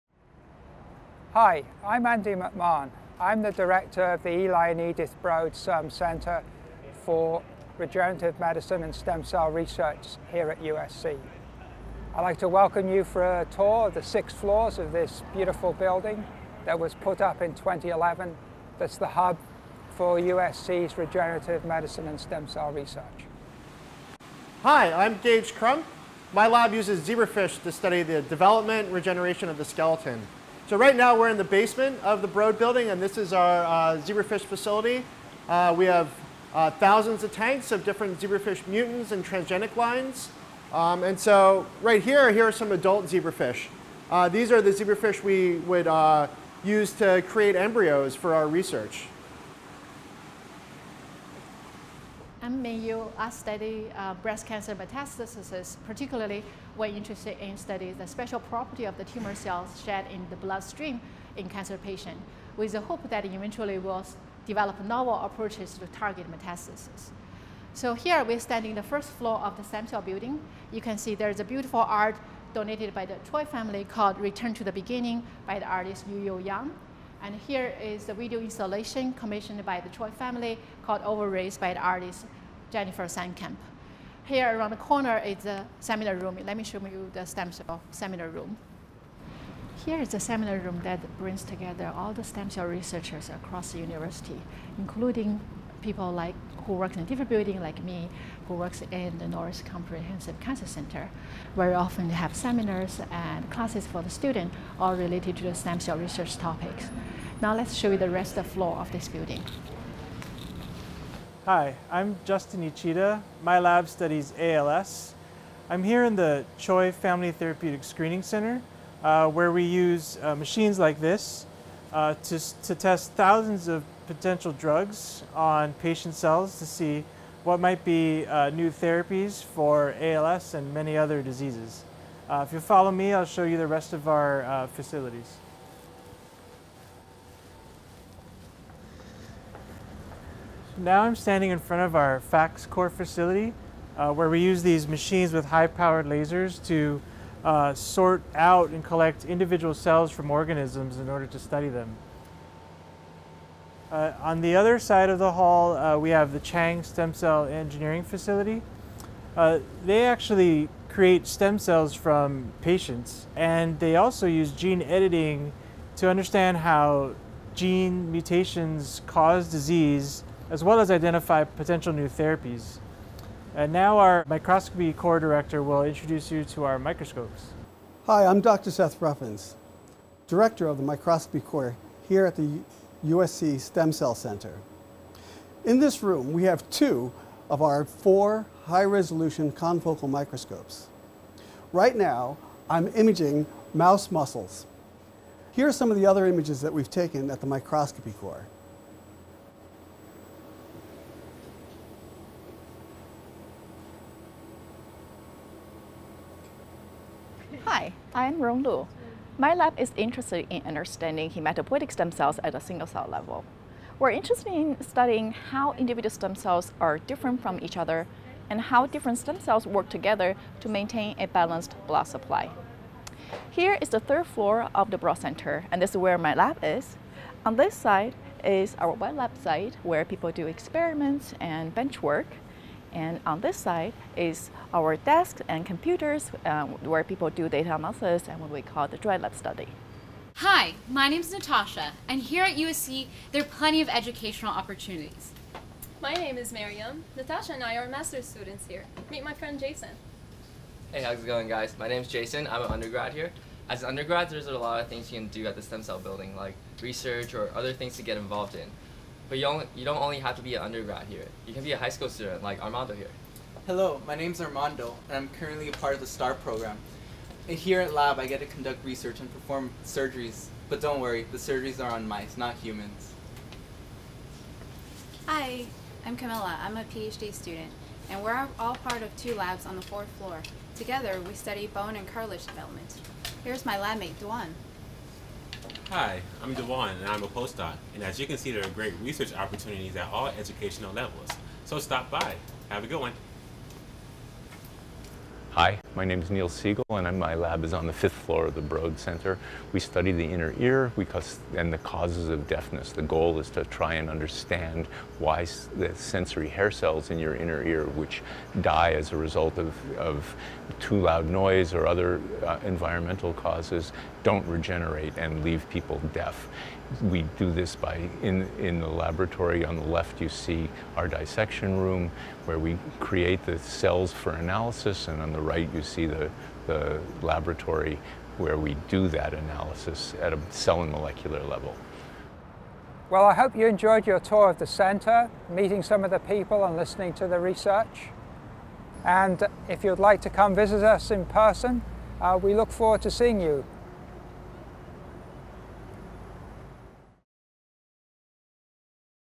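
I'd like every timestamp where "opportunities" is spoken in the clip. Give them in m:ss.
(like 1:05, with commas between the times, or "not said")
4:04, 4:49.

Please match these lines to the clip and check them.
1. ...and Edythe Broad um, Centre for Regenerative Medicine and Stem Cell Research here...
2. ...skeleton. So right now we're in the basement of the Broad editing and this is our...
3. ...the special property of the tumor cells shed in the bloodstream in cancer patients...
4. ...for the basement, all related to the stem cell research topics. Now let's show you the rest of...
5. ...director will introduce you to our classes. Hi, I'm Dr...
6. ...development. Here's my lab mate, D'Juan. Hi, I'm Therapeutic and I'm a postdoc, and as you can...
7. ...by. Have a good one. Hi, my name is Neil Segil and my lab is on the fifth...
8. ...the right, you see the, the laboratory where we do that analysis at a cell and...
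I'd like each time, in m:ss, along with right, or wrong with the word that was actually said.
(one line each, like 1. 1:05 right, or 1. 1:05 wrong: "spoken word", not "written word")
1. 0:04 right
2. 0:29 wrong: "building", not "editing"
3. 0:57 right
4. 1:43 wrong: "student", not "basement"
5. 2:55 wrong: "microscopes", not "classes"
6. 4:42 wrong: "Devon", not "Therapeutic"
7. 4:52 right
8. 5:25 right.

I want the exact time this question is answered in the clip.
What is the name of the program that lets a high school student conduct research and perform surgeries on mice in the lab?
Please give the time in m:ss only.
4:26.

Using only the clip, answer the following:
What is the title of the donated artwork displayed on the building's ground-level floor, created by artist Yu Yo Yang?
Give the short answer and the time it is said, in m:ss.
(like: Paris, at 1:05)
Return to the Beginning, at 1:14.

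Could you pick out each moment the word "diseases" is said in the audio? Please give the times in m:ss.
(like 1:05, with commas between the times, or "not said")
2:11, 2:49.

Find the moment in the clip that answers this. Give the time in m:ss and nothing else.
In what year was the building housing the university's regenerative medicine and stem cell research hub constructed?
0:17.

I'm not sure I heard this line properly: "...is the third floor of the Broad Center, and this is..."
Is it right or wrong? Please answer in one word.
right.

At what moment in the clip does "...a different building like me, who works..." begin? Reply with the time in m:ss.
1:37.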